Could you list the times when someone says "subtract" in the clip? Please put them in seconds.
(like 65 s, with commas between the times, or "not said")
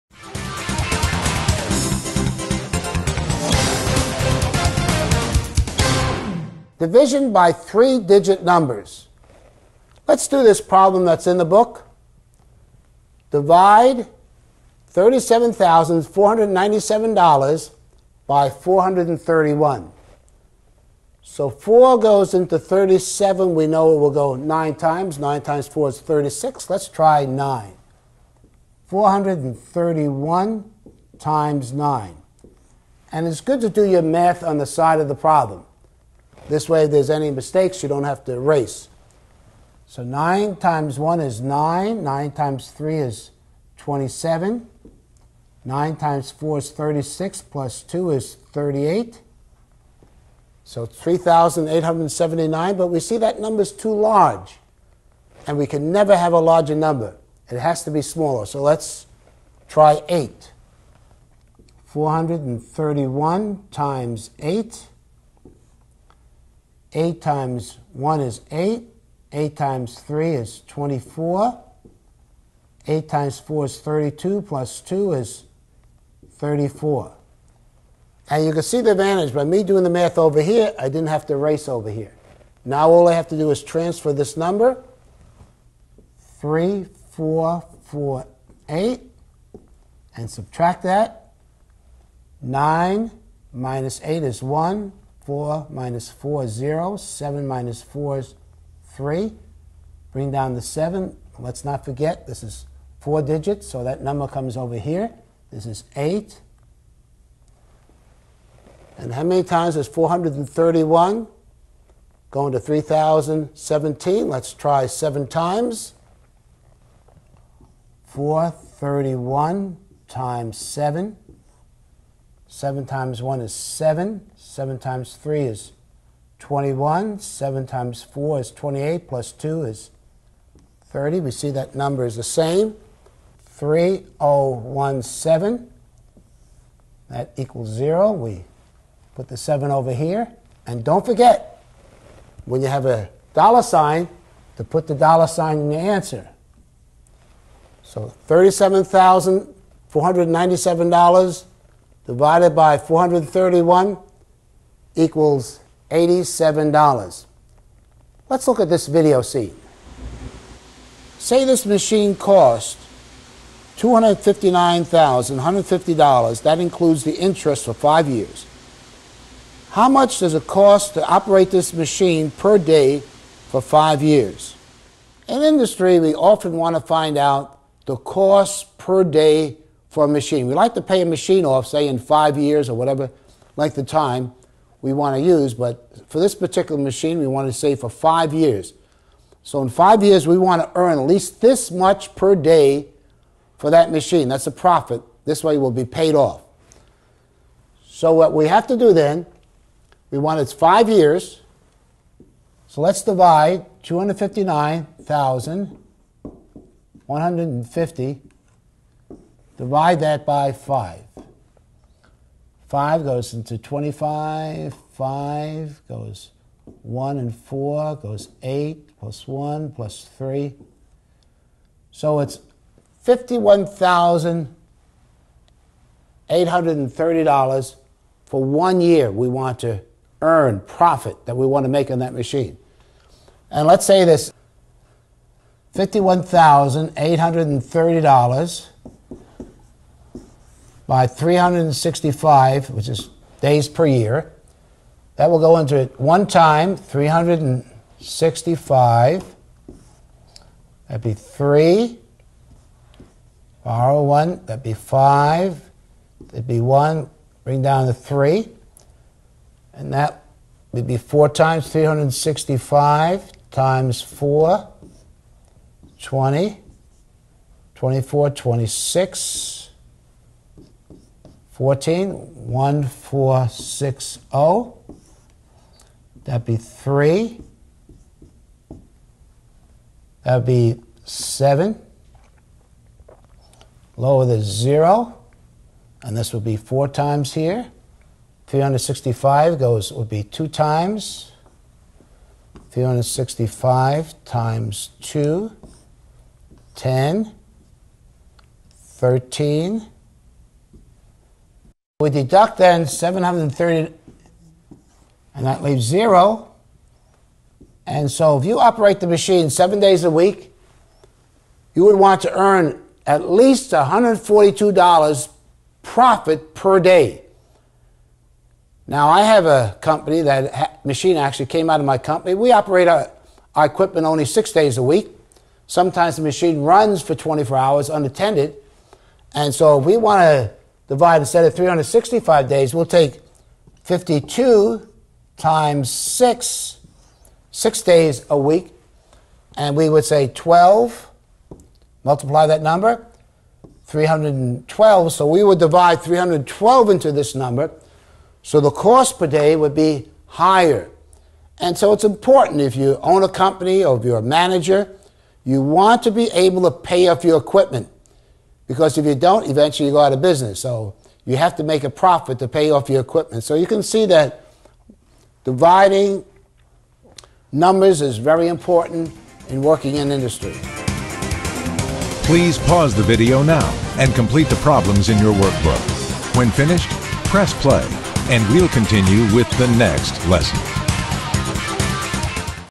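90 s.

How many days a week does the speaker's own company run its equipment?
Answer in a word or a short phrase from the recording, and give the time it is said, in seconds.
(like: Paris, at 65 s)
6, at 324 s.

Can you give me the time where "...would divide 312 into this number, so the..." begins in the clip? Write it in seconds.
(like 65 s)
345 s.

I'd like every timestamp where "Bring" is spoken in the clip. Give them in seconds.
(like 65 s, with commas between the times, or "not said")
100 s, 257 s.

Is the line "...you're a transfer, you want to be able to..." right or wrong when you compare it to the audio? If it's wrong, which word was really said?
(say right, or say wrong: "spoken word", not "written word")
wrong: "manager", not "transfer".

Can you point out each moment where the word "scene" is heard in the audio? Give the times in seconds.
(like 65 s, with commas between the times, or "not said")
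159 s.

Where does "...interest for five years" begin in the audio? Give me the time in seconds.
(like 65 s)
167 s.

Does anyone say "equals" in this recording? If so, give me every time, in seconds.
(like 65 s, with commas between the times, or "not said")
137 s, 154 s.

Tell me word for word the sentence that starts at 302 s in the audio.
We deduct then 730, and that leaves zero.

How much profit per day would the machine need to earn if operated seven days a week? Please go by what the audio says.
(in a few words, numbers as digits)
$142.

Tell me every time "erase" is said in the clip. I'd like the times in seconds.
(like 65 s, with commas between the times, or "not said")
38 s, 81 s.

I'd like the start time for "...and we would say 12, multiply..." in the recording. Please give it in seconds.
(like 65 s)
339 s.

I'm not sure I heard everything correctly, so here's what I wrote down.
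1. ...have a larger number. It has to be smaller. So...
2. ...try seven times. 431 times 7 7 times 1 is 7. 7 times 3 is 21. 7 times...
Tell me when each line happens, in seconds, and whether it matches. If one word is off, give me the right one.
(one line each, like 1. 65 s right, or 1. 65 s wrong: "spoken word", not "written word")
1. 56 s right
2. 114 s right.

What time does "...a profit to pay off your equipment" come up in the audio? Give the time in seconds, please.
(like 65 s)
361 s.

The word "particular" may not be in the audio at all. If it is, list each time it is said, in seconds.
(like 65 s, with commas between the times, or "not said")
186 s.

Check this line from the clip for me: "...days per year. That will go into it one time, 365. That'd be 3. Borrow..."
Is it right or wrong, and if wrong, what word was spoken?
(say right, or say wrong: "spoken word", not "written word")
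right.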